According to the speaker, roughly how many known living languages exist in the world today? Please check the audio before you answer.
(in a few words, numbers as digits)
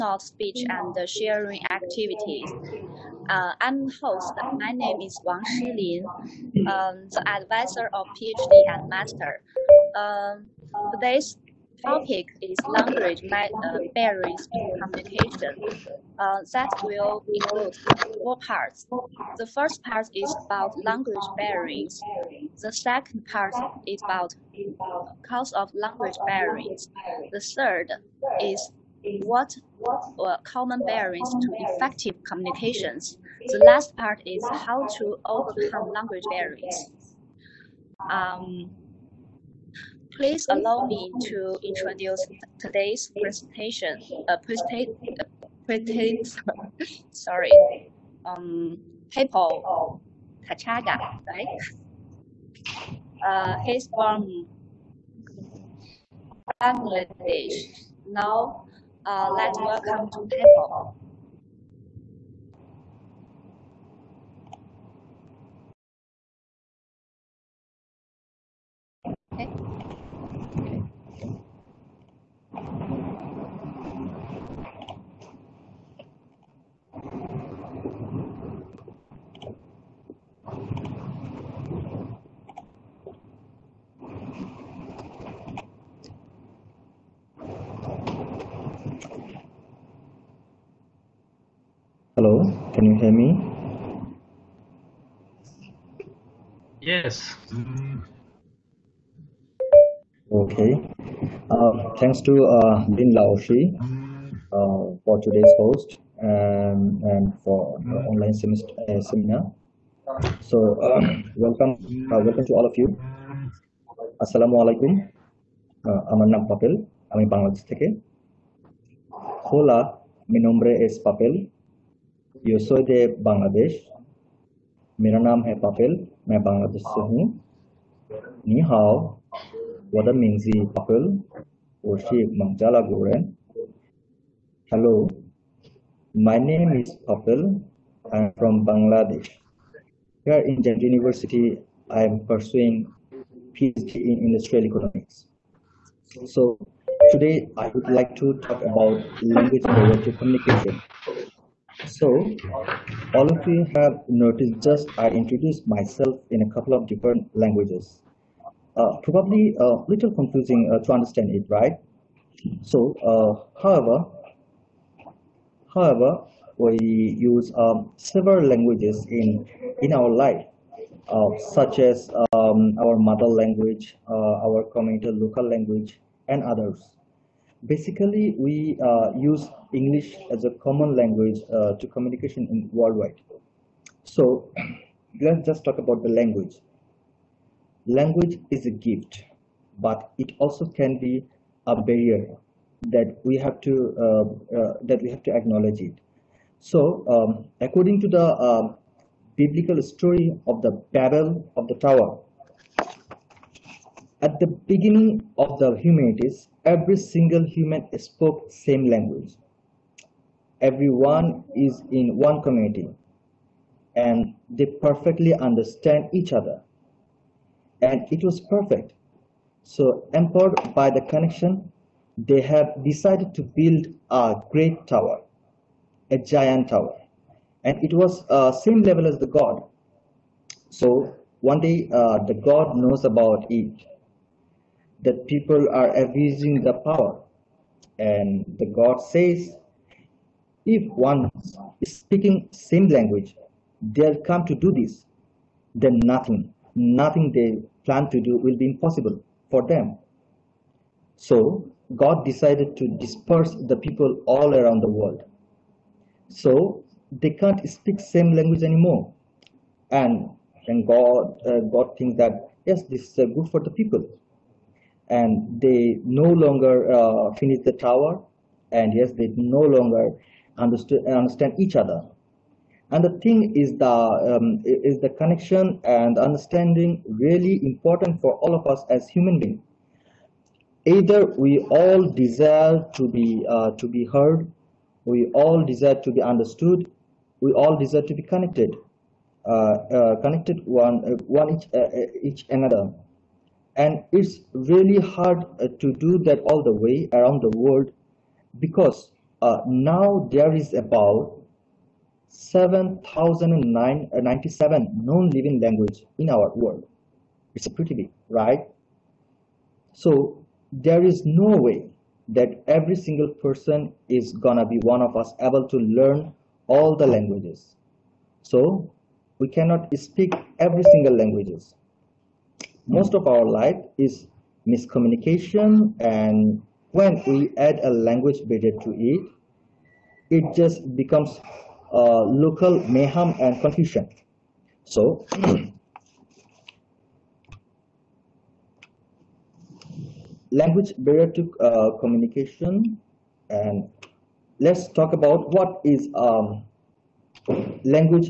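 7,097.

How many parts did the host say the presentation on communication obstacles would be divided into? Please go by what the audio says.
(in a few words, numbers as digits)
4.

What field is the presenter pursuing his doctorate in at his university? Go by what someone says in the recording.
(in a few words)
Industrial economics.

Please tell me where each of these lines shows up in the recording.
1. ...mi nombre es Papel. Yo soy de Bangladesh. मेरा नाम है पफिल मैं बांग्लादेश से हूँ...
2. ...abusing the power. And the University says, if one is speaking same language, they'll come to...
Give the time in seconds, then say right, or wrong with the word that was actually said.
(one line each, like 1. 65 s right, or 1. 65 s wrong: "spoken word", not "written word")
1. 120 s right
2. 236 s wrong: "God", not "University".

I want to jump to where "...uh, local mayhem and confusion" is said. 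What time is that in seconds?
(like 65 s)
331 s.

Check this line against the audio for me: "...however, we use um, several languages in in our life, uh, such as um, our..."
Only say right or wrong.
right.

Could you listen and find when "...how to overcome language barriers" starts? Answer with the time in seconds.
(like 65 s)
34 s.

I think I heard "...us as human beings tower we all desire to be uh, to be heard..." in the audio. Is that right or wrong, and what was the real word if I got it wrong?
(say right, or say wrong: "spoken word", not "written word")
wrong: "either", not "tower".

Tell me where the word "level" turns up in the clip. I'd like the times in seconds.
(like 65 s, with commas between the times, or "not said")
228 s.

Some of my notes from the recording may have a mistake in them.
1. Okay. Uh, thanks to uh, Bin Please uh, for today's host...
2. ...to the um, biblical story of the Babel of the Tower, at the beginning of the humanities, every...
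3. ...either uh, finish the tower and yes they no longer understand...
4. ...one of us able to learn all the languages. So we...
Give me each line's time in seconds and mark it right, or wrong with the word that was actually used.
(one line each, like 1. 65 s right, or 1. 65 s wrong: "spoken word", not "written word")
1. 100 s wrong: "Laoshi", not "Please"
2. 197 s right
3. 266 s wrong: "longer", not "either"
4. 314 s right.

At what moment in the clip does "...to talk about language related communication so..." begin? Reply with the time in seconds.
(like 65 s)
148 s.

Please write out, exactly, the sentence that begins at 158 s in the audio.
Uh, probably a little confusing uh, to understand it, right?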